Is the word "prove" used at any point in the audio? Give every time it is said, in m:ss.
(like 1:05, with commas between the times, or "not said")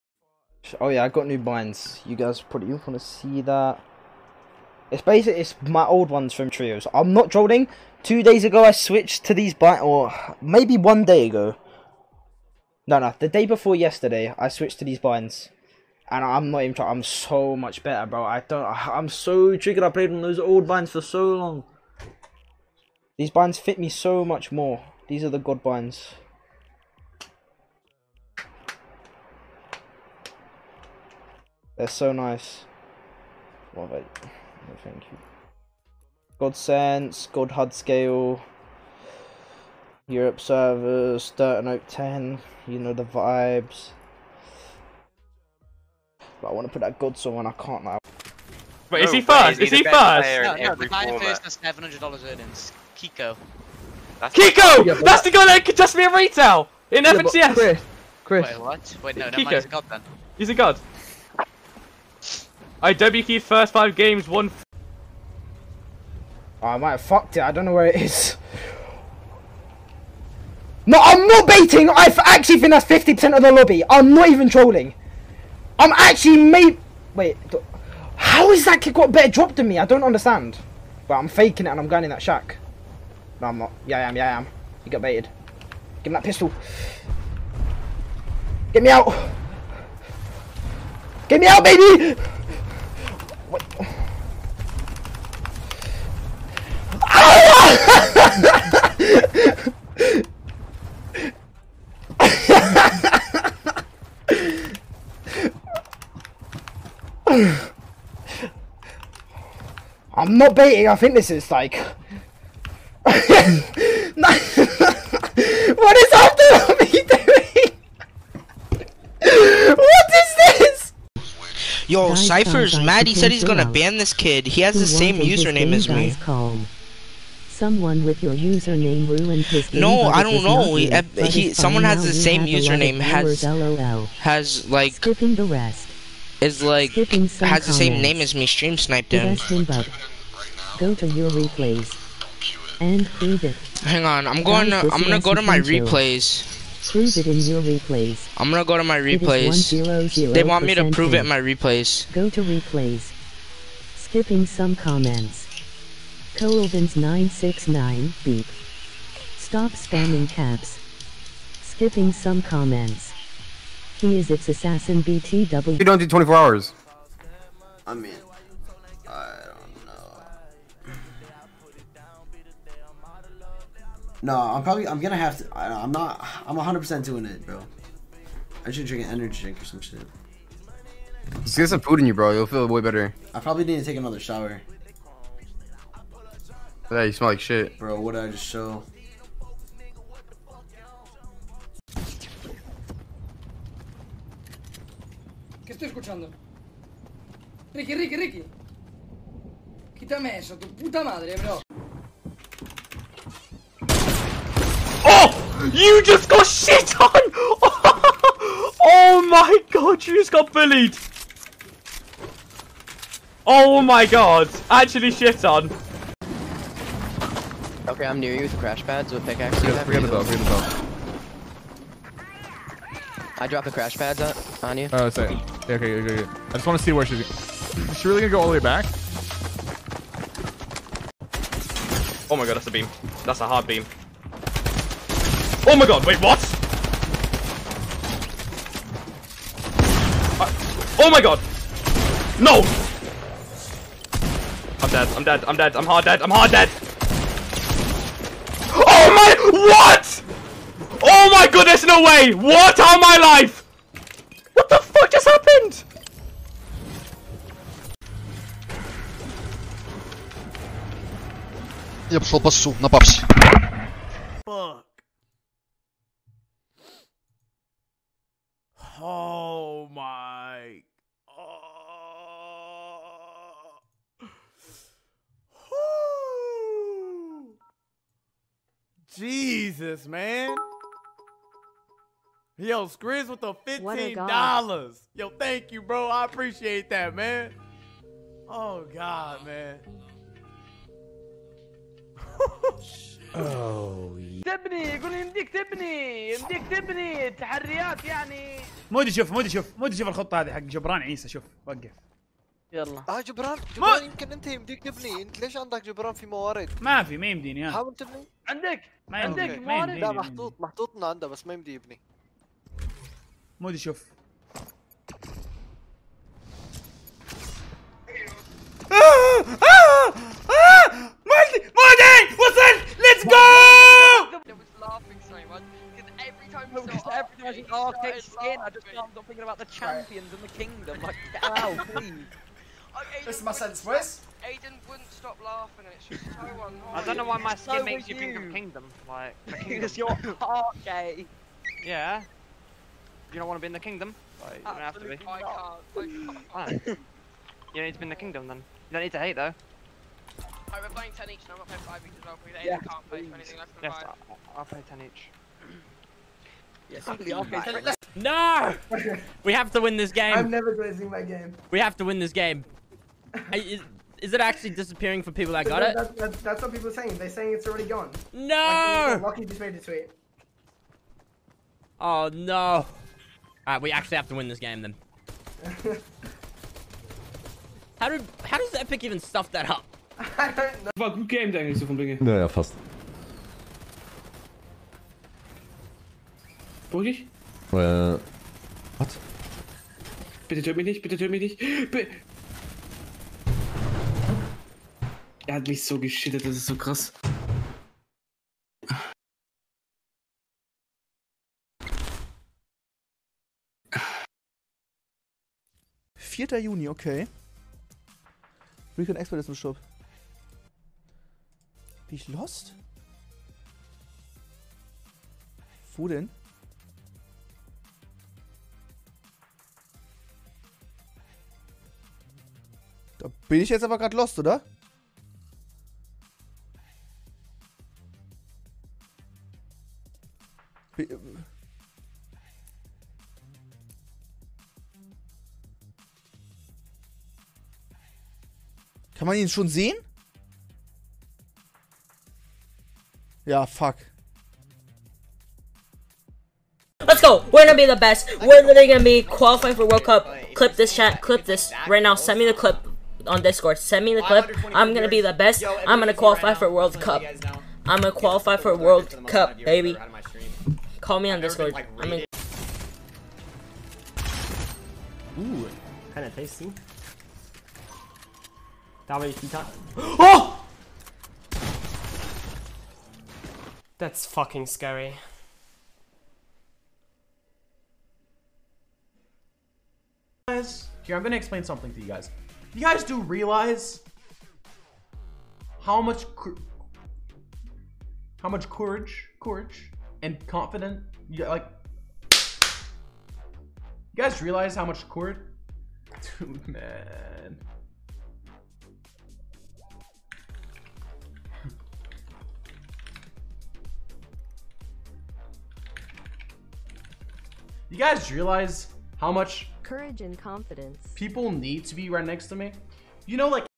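2:26, 2:30.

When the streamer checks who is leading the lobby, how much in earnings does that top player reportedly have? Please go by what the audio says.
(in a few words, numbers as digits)
$700.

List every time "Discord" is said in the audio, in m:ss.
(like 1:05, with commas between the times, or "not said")
7:33, 7:41.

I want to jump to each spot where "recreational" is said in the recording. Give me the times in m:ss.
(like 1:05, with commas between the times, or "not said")
not said.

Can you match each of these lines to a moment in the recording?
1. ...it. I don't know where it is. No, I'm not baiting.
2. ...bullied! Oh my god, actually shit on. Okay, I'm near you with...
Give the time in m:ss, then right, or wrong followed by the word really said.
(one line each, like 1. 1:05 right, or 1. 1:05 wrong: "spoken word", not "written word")
1. 1:07 right
2. 3:30 right.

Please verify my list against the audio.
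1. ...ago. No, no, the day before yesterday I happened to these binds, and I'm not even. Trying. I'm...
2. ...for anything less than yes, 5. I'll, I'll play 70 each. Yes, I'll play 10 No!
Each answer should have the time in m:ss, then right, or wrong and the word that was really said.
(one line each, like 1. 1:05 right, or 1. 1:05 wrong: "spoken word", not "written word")
1. 0:11 wrong: "switched", not "happened"
2. 5:53 wrong: "10", not "70".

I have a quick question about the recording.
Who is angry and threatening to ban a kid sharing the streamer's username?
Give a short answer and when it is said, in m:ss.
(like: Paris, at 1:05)
Cypher, at 2:02.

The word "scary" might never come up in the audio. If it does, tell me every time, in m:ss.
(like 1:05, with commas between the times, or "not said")
7:54.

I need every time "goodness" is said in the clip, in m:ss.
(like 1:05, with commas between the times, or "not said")
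4:11.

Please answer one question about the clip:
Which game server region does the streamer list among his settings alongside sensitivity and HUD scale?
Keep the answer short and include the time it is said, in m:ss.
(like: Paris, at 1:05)
Europe, at 0:40.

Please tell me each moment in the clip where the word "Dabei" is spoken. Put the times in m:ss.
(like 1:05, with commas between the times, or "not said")
7:49.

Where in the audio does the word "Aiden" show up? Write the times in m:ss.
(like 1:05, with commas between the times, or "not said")
5:34, 5:52.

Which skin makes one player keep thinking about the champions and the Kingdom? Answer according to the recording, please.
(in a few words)
Arctic skin.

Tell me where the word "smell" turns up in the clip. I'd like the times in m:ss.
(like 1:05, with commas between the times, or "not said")
3:07.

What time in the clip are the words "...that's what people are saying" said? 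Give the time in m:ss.
6:06.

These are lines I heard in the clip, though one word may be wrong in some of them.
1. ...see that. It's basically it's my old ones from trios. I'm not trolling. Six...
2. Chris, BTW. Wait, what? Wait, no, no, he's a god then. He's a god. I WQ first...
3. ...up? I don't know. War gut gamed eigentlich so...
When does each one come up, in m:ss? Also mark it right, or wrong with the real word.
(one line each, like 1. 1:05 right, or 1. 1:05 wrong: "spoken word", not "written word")
1. 0:02 wrong: "Two", not "Six"
2. 0:57 wrong: "Chris", not "BTW"
3. 6:19 right.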